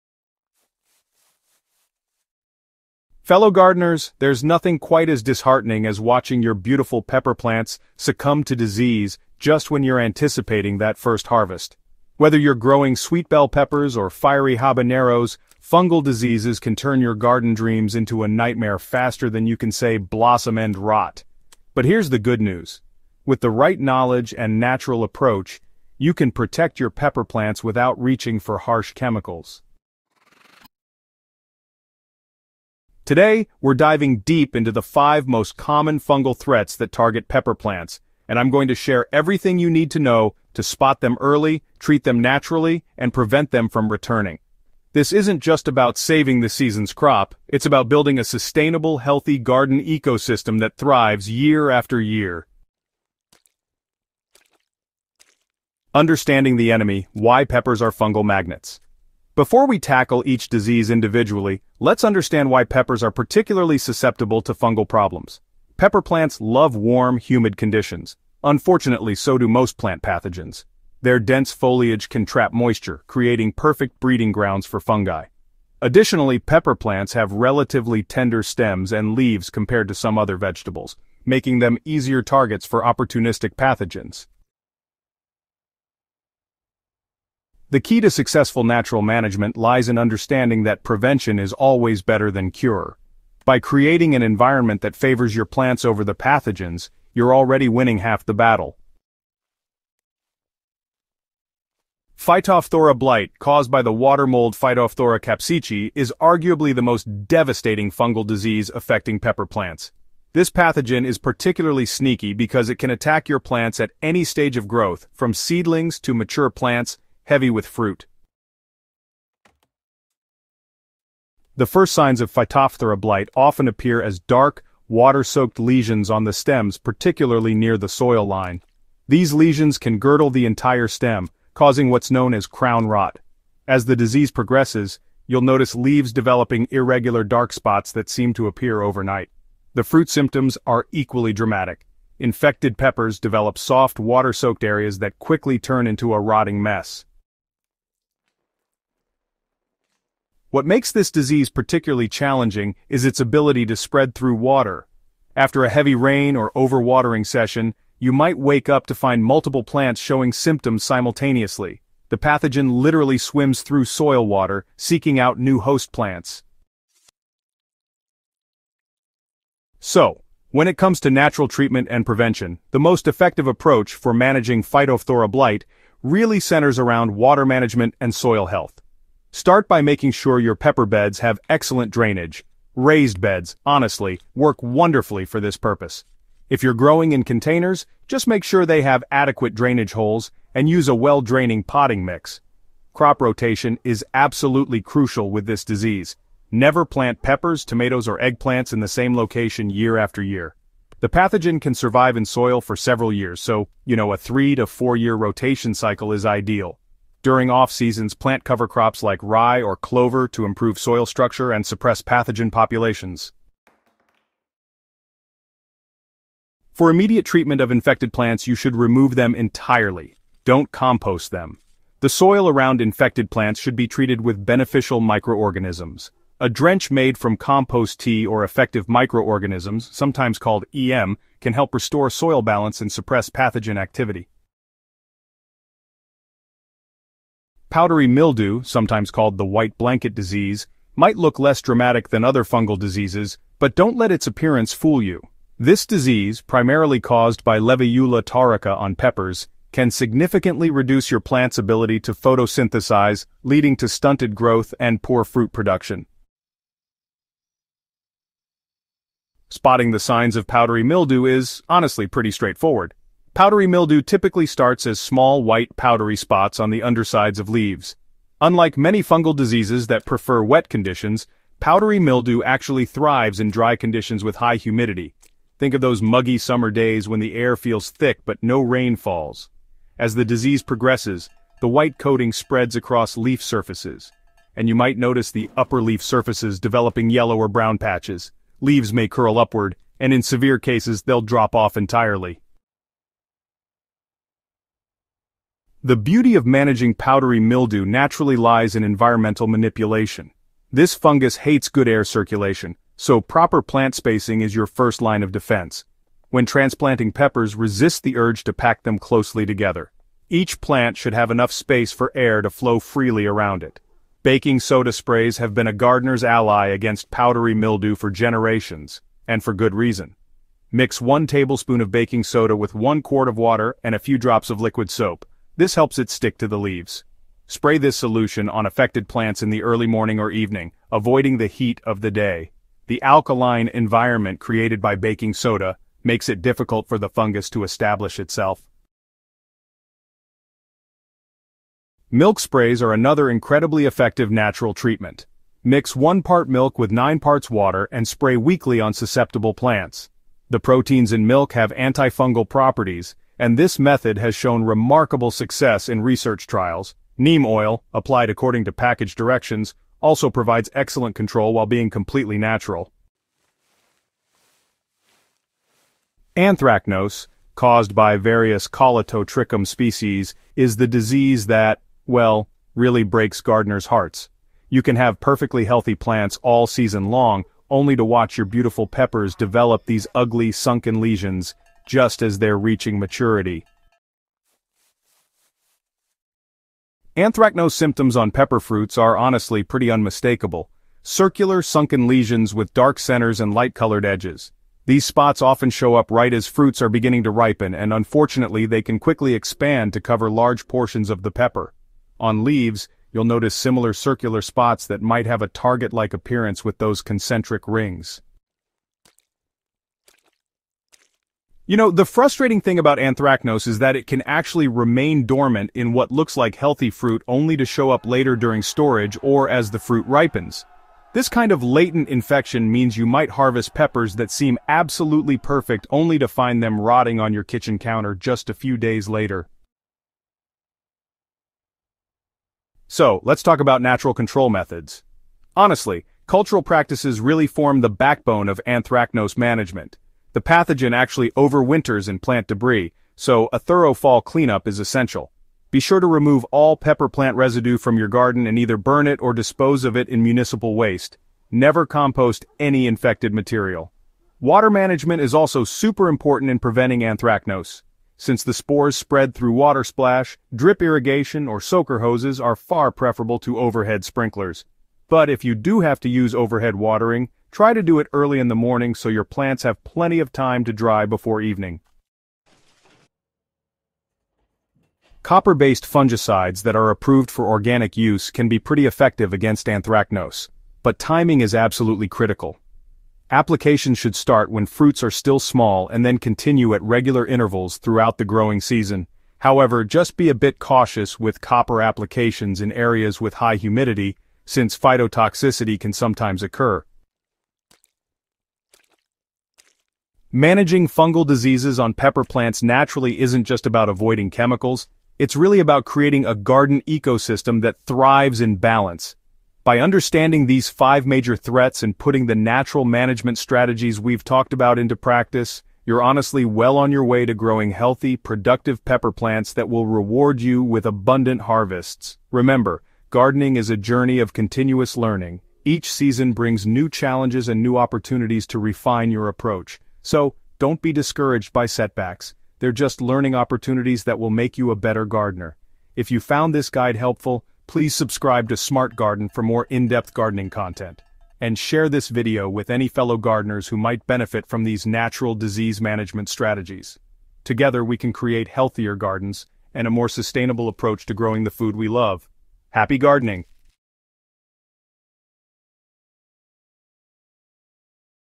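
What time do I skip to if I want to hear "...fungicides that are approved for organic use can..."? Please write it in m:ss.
7:55.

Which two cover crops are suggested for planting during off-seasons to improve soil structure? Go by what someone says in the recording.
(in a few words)
Rye or clover.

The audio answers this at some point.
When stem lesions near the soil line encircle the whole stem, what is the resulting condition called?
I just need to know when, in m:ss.
2:12.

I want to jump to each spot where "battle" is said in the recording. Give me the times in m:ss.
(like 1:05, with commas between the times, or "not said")
1:38.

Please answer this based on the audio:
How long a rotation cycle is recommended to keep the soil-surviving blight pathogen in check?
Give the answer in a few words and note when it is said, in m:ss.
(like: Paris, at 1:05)
3 to 4 years, at 3:24.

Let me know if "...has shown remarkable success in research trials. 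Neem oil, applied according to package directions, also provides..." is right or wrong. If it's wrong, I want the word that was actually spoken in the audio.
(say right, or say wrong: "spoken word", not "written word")
right.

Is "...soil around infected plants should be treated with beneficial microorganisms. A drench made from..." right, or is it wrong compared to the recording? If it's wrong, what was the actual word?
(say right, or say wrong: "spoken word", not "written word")
right.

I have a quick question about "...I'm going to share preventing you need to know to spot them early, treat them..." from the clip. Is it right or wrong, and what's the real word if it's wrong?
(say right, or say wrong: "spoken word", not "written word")
wrong: "everything", not "preventing".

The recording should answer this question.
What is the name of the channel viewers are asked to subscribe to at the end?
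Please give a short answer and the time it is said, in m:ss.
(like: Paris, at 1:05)
Smart Garden, at 8:58.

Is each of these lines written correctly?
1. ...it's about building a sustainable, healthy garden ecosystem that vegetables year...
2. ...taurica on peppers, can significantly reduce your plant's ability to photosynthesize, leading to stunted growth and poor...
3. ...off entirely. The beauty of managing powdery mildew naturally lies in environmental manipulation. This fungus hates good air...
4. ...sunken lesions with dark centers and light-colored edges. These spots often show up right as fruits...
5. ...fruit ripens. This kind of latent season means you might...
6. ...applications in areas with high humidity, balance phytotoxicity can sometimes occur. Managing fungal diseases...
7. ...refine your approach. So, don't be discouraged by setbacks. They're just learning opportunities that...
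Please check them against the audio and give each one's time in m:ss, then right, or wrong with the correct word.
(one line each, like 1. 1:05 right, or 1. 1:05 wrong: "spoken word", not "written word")
1. 0:47 wrong: "thrives", not "vegetables"
2. 4:08 right
3. 4:51 right
4. 6:31 right
5. 6:59 wrong: "infection", not "season"
6. 8:11 wrong: "since", not "balance"
7. 8:48 right.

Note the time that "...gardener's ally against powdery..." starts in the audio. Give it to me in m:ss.
5:15.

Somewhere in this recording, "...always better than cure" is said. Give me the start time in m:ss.
1:31.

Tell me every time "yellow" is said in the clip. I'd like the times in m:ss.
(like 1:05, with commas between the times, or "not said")
4:47.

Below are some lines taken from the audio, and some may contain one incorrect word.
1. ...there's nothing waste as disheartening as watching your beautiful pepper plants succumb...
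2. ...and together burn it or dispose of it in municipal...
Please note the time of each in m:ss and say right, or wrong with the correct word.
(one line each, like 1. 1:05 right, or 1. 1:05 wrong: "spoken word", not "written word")
1. 0:04 wrong: "quite", not "waste"
2. 7:28 wrong: "either", not "together".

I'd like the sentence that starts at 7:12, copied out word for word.
So, let's talk about natural control methods.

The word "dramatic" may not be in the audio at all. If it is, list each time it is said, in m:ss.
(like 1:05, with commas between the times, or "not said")
2:21, 4:01.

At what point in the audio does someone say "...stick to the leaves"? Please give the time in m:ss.
5:26.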